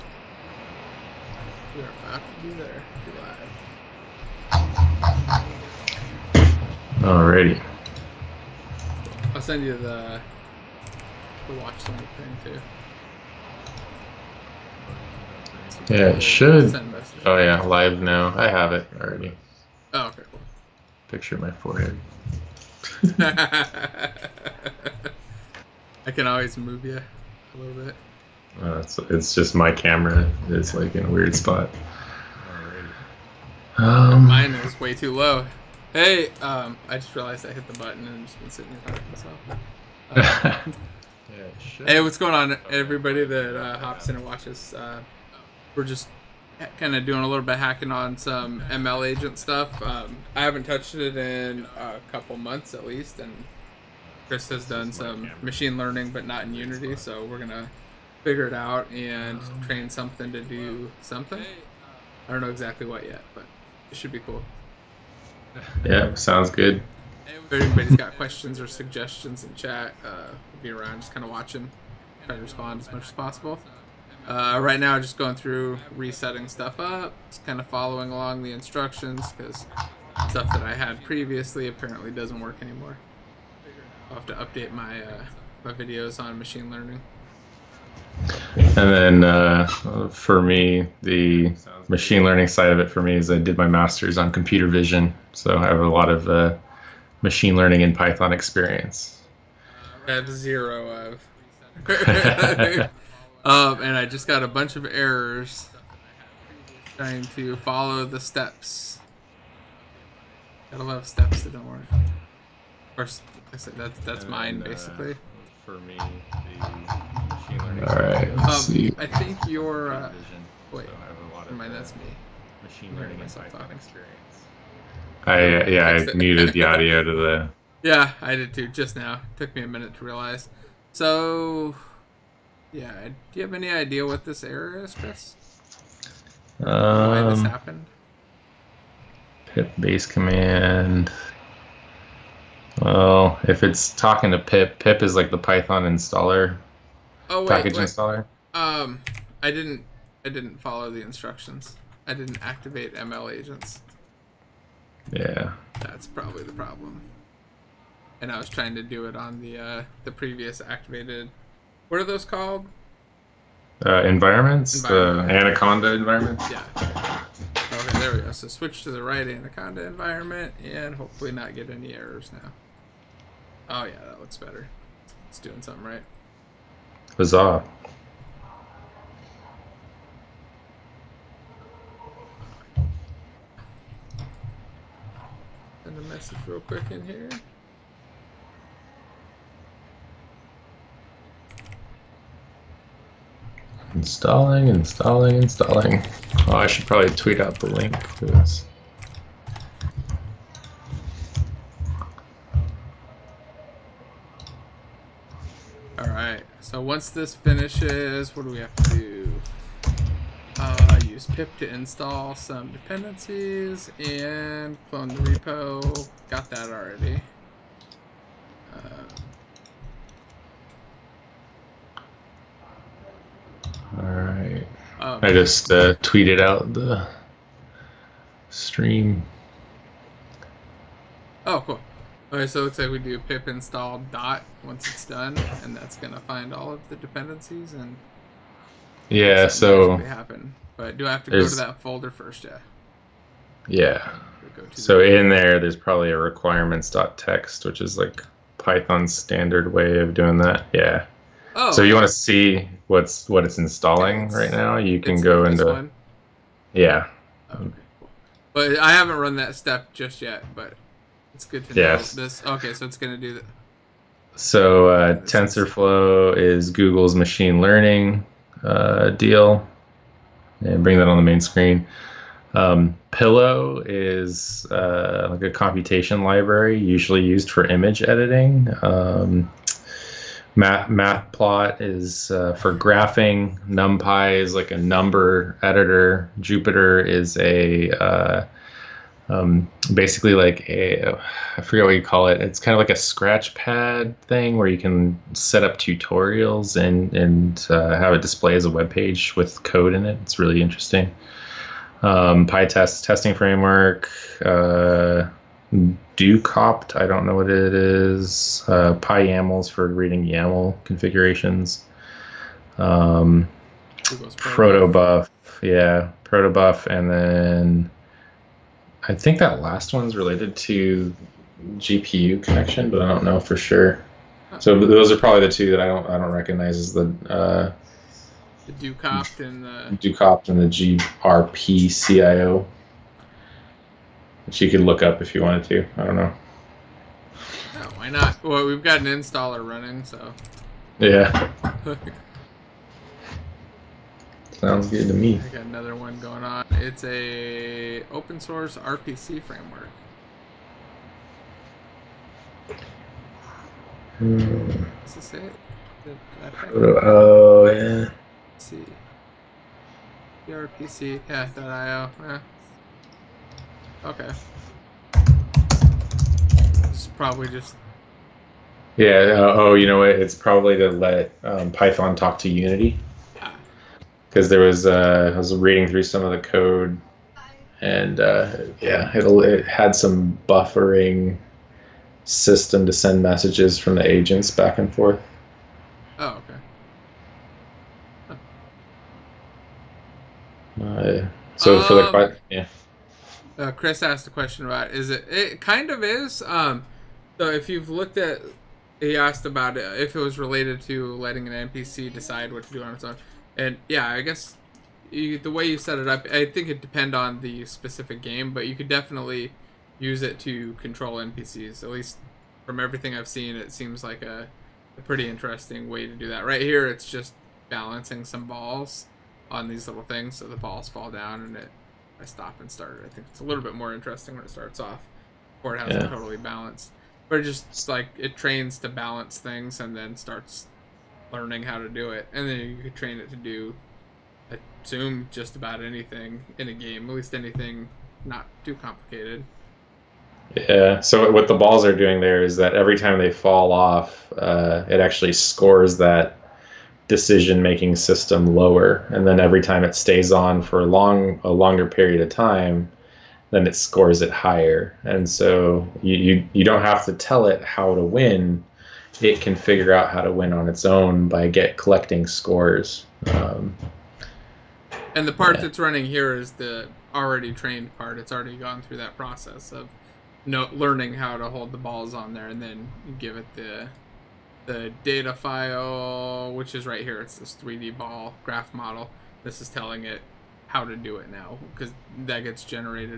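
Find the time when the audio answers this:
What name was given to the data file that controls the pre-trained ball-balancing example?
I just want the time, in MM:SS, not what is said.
07:57.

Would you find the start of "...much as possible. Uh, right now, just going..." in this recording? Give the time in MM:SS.
01:12.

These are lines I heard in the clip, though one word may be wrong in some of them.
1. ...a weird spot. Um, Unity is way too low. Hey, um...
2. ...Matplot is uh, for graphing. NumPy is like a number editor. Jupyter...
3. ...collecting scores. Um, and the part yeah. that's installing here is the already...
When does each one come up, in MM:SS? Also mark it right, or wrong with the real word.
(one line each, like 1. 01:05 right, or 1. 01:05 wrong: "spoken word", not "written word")
1. 00:31 wrong: "Mine", not "Unity"
2. 04:40 right
3. 07:41 wrong: "running", not "installing".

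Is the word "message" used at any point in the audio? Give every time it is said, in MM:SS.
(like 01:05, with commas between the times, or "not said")
03:06, 06:23.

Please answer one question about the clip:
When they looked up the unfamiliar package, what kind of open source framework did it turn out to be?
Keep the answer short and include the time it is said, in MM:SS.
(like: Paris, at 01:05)
RPC framework, at 05:48.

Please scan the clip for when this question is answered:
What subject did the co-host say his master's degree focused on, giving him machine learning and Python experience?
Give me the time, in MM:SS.
01:34.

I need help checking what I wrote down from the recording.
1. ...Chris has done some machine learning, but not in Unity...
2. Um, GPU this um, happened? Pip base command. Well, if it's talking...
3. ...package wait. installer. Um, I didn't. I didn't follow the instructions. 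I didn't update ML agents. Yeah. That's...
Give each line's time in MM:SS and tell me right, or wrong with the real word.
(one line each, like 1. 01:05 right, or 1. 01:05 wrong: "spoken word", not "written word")
1. 00:54 right
2. 02:16 wrong: "Why", not "GPU"
3. 02:27 wrong: "activate", not "update".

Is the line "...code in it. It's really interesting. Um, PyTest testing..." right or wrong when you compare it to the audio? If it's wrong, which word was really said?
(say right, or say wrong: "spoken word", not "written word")
right.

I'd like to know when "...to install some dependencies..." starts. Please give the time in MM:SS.
03:31.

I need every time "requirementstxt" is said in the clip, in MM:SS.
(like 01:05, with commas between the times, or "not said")
04:06.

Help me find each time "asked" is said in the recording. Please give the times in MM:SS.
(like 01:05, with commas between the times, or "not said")
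06:34, 06:39.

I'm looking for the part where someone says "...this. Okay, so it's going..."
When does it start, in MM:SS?
04:22.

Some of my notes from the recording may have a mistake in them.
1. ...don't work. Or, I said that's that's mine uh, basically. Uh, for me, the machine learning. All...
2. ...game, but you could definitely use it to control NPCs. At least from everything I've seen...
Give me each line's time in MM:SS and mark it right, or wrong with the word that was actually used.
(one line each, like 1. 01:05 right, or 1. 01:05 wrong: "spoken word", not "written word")
1. 01:51 right
2. 06:48 right.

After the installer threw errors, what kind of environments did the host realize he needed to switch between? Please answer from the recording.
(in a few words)
Anaconda environments.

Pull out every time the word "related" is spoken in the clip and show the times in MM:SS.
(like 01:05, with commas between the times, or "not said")
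05:20, 06:40.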